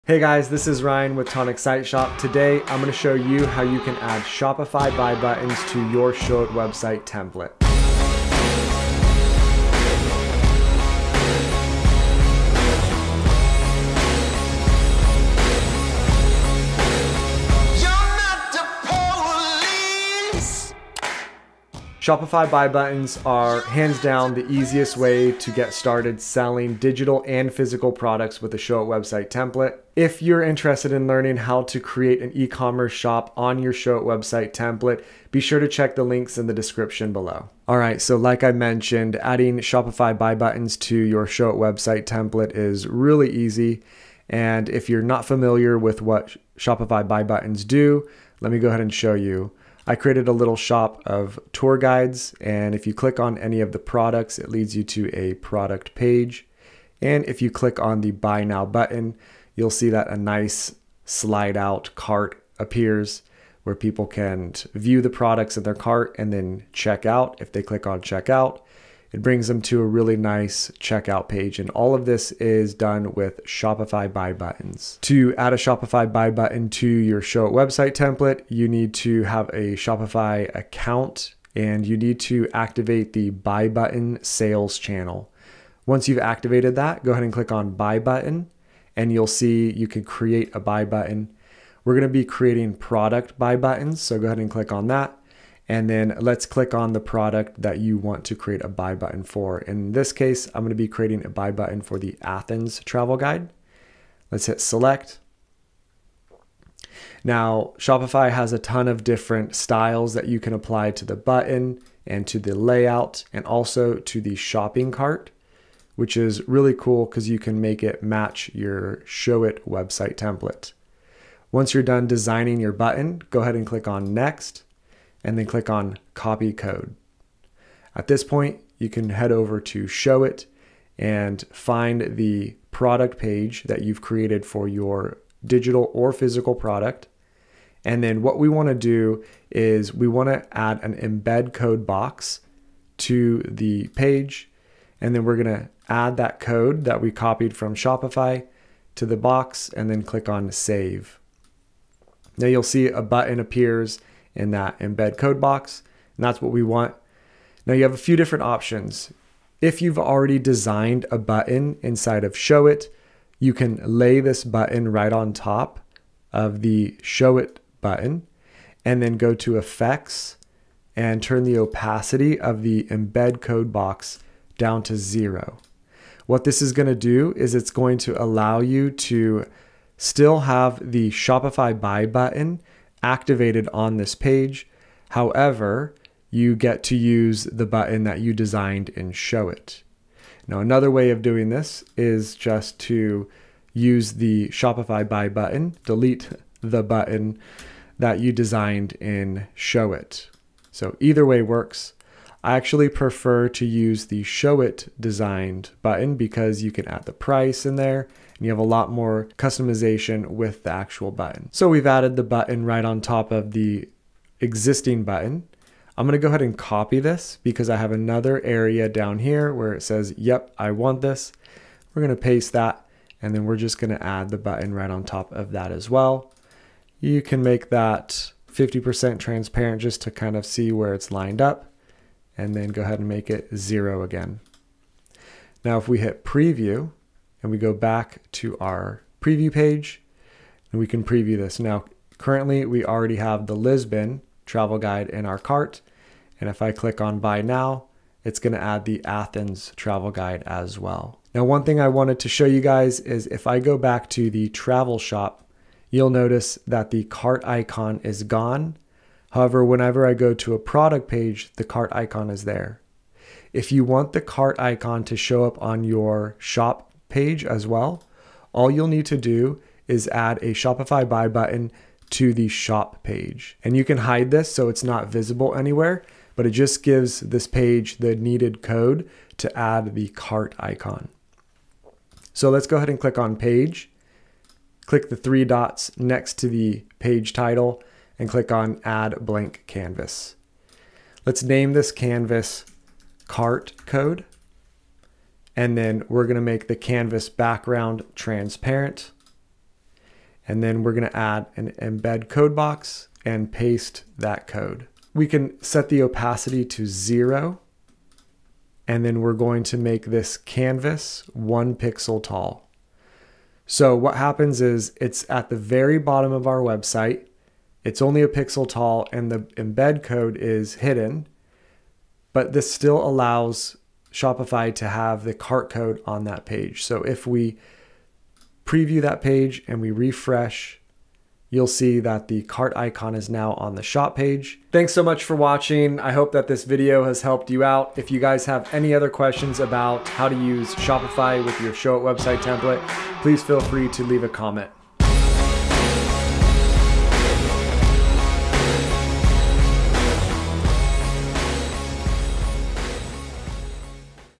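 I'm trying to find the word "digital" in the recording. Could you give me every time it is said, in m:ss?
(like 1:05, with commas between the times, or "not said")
0:26, 2:15.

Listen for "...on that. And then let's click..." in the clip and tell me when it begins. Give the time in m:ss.
1:34.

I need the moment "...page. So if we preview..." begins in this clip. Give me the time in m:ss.
5:26.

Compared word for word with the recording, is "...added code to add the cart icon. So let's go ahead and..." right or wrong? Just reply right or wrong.
wrong.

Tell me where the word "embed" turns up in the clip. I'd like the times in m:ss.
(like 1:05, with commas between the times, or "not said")
2:20, 2:34, 2:52, 5:01, 5:19.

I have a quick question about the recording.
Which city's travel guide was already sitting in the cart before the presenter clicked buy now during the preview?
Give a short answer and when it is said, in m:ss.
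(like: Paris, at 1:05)
Lisbon, at 4:03.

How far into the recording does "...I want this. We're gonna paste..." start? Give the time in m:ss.
3:40.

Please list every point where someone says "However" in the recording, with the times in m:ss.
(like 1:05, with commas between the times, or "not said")
3:05, 4:19.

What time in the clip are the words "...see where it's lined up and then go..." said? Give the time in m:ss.
3:50.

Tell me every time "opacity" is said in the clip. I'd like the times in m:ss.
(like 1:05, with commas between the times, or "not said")
2:51, 5:06.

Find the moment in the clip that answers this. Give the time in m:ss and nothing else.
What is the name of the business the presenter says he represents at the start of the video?
0:01.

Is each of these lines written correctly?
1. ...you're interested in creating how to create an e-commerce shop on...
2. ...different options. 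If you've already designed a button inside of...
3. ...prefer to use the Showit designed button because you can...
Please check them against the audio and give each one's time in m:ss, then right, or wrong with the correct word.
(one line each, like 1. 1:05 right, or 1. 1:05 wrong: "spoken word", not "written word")
1. 0:30 wrong: "learning", not "creating"
2. 2:38 right
3. 3:22 right.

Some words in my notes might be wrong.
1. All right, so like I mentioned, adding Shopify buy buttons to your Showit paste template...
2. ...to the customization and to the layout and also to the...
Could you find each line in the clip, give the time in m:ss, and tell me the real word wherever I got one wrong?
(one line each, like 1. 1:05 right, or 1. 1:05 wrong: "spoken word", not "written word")
1. 0:37 wrong: "website", not "paste"
2. 1:50 wrong: "button", not "customization".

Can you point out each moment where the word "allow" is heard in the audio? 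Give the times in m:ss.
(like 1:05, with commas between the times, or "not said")
2:58, 5:23.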